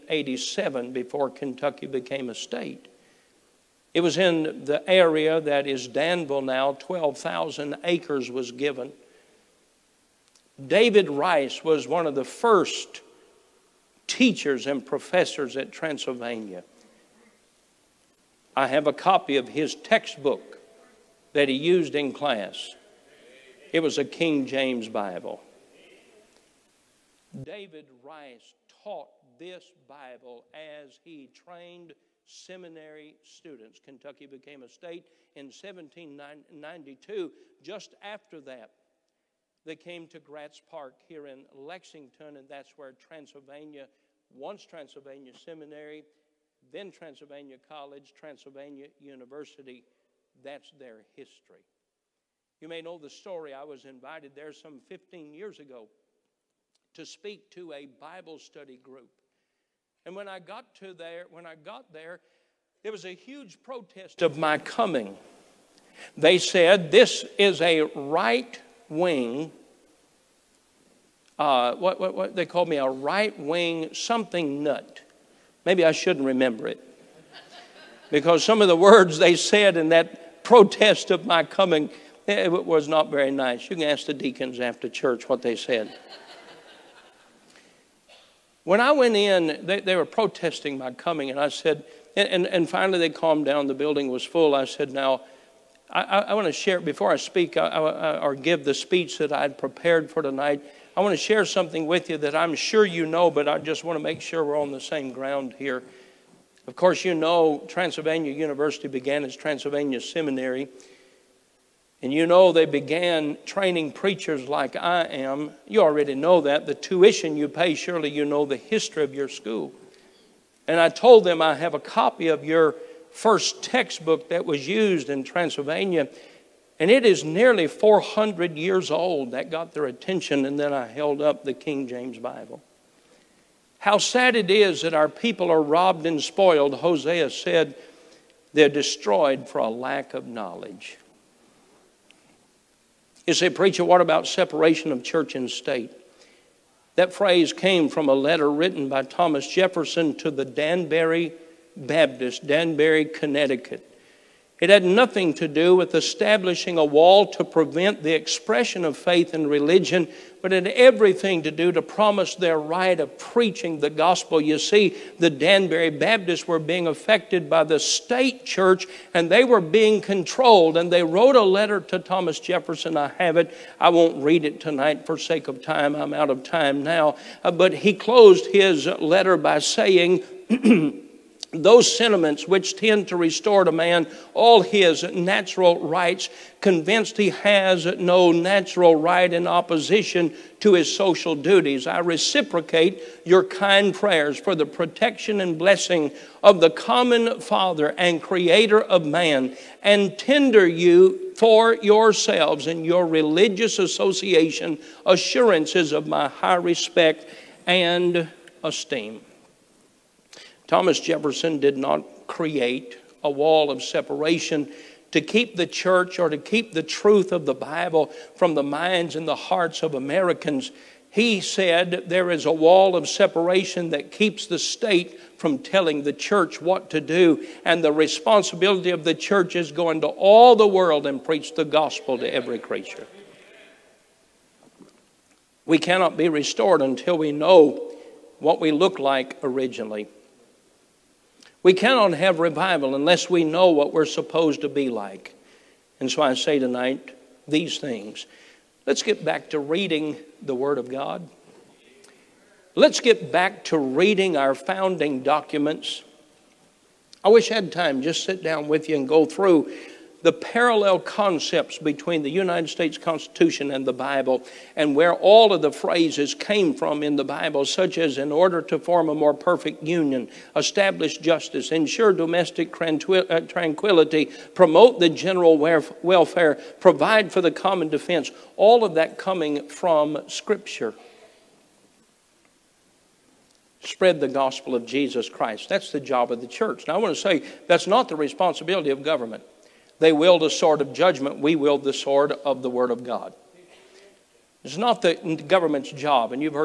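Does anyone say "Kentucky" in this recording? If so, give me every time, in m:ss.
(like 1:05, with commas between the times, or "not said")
0:01, 0:33.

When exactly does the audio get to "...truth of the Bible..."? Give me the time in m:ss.
3:36.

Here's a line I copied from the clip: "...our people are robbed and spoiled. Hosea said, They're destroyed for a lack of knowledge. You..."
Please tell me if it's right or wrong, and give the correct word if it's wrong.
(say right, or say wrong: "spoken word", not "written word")
right.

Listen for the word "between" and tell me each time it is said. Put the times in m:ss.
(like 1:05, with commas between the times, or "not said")
4:21.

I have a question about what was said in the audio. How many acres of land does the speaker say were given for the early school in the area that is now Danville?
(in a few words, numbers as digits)
12,000.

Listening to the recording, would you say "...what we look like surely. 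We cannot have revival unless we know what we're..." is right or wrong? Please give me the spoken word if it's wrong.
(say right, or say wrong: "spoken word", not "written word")
wrong: "originally", not "surely".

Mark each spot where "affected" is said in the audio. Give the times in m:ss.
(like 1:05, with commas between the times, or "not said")
2:46.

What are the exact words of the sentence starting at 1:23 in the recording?
You can ask the deacons after church what they said.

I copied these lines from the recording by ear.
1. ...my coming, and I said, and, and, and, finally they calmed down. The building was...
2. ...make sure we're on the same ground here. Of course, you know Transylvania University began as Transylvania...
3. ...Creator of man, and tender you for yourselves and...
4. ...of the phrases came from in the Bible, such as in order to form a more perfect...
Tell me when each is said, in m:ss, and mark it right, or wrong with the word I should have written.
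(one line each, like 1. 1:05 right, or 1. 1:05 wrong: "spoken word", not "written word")
1. 1:30 right
2. 1:44 right
3. 3:18 right
4. 4:25 right.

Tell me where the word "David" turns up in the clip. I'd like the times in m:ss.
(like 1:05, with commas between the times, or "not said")
0:10, 0:27.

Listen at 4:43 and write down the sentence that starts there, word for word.
Spread the gospel of Jesus Christ.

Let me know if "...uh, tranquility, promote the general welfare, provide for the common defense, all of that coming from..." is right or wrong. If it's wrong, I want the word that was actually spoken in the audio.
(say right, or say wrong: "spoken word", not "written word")
right.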